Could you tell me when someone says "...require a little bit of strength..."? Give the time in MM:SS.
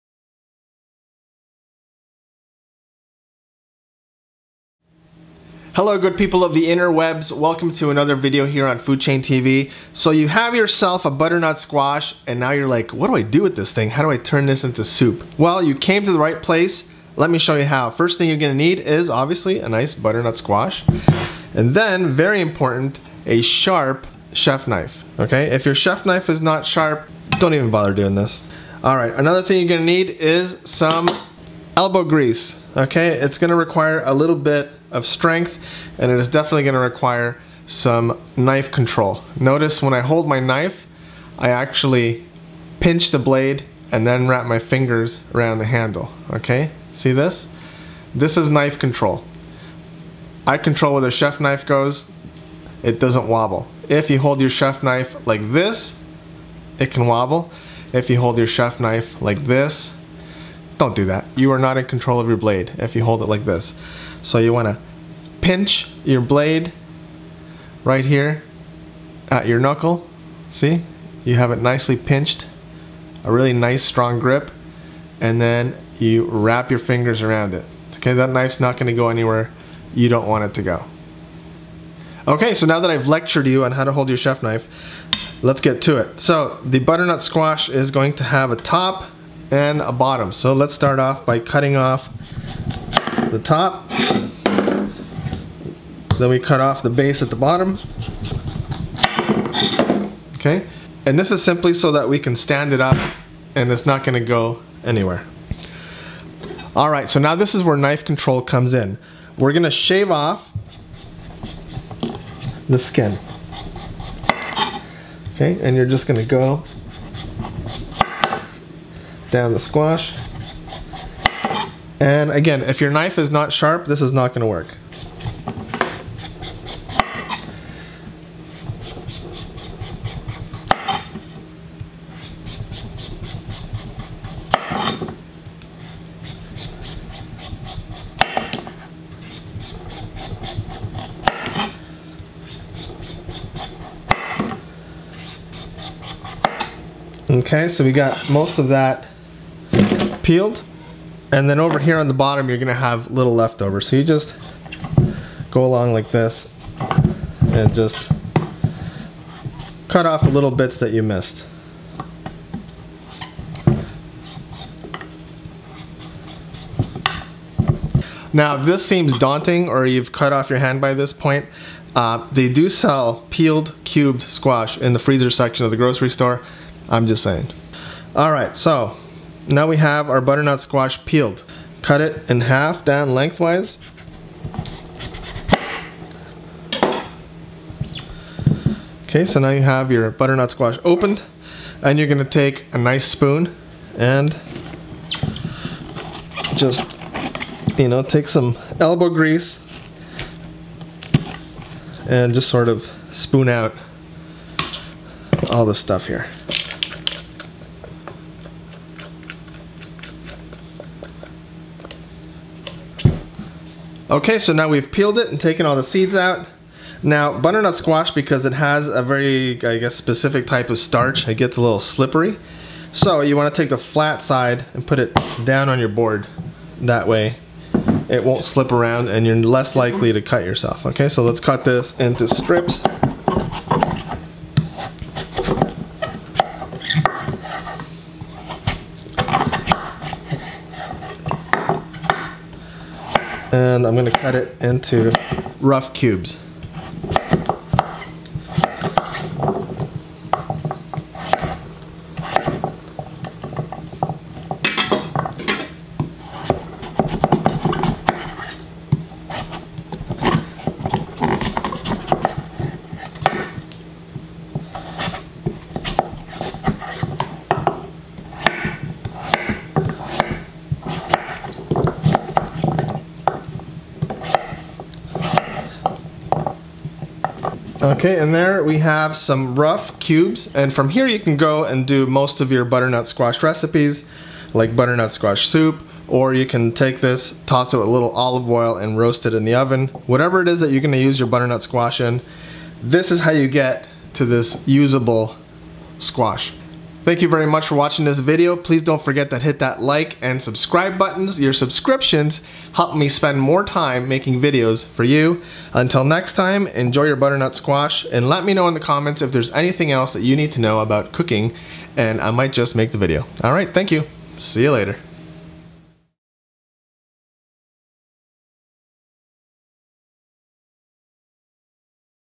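00:33.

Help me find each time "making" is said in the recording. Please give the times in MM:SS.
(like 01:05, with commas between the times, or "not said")
05:04.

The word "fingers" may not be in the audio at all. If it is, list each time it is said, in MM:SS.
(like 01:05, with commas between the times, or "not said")
00:44, 01:16.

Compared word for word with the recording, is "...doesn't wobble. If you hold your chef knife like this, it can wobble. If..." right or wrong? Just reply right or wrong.
right.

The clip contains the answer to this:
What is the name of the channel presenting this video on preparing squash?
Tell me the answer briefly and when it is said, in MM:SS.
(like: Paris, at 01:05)
Food Chain TV, at 00:08.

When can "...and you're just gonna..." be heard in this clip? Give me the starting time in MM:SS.
01:55.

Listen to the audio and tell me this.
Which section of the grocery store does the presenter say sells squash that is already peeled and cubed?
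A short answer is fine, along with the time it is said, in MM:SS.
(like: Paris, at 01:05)
freezer section, at 02:54.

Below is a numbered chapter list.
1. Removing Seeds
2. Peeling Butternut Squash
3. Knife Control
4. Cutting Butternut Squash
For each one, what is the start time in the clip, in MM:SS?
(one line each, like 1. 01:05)
1. 02:58
2. 01:22
3. 00:12
4. 03:34.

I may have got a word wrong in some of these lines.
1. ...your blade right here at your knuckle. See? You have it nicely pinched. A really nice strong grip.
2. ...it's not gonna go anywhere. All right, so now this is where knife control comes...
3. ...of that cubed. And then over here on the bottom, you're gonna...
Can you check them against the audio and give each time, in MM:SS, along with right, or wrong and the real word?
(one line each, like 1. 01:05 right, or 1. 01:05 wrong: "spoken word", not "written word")
1. 01:06 right
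2. 01:43 right
3. 02:28 wrong: "peeled", not "cubed".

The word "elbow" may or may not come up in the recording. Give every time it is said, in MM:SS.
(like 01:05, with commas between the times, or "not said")
00:31, 03:18.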